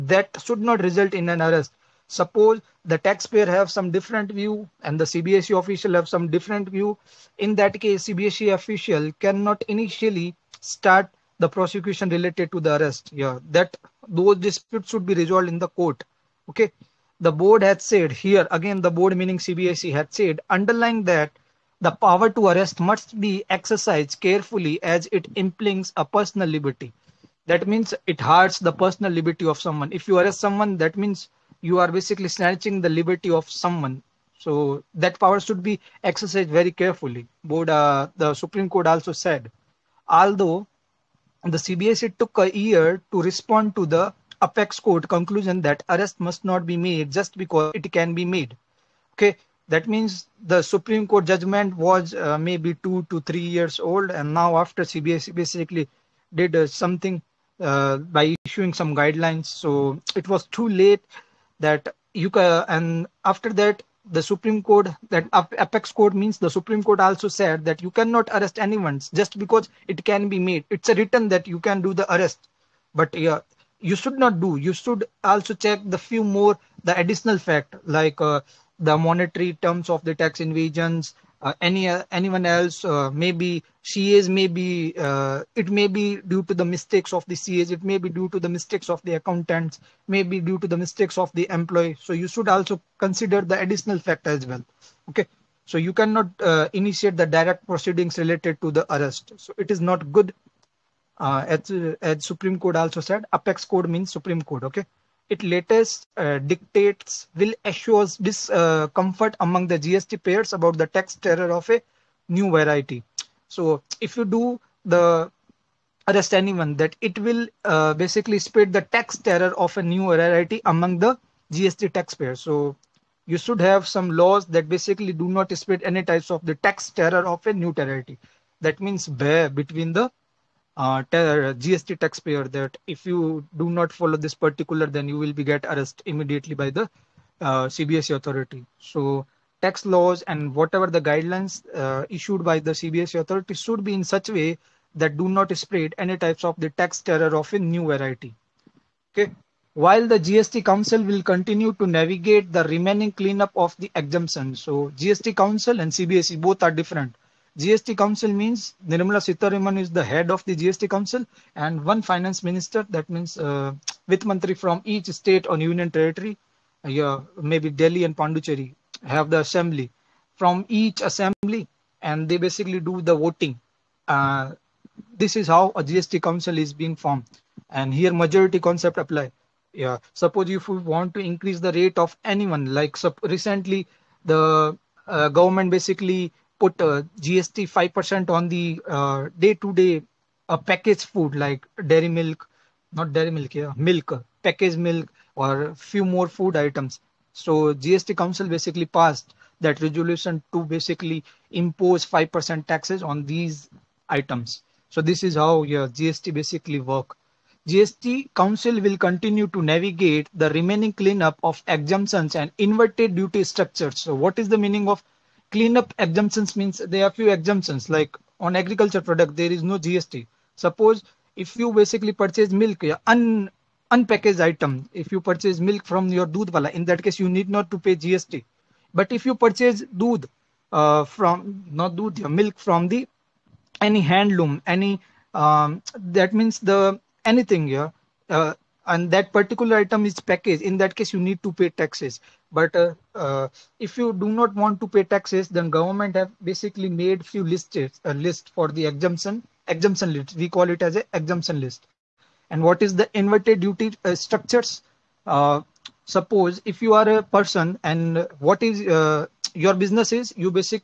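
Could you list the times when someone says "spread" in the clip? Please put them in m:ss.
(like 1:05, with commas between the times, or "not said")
1:58, 2:05, 2:25.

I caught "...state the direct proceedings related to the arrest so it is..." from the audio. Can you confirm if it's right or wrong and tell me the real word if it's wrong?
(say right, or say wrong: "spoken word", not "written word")
wrong: "initiate", not "state".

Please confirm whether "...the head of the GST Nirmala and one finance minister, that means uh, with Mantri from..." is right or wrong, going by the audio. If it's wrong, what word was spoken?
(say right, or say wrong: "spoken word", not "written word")
wrong: "Council", not "Nirmala".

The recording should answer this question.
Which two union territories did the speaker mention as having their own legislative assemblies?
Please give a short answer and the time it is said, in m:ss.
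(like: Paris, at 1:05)
Delhi and Pondicherry, at 2:47.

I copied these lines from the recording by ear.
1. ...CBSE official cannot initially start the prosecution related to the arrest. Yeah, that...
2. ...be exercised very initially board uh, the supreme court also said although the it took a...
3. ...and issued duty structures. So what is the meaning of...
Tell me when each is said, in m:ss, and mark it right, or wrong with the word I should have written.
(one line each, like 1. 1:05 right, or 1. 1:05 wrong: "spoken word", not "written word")
1. 0:08 right
2. 0:35 wrong: "carefully", not "initially"
3. 3:32 wrong: "inverted", not "issued".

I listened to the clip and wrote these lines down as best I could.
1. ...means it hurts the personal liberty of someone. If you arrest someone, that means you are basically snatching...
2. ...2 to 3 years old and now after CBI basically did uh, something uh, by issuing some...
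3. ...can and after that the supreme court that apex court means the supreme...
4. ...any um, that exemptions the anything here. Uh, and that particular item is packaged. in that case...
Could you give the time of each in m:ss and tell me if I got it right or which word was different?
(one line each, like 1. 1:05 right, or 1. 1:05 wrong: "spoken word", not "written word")
1. 0:27 right
2. 0:52 right
3. 1:02 right
4. 3:54 wrong: "means", not "exemptions".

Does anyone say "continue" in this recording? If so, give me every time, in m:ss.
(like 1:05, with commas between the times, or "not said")
2:31, 3:28.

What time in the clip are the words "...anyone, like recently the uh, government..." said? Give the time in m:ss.
3:02.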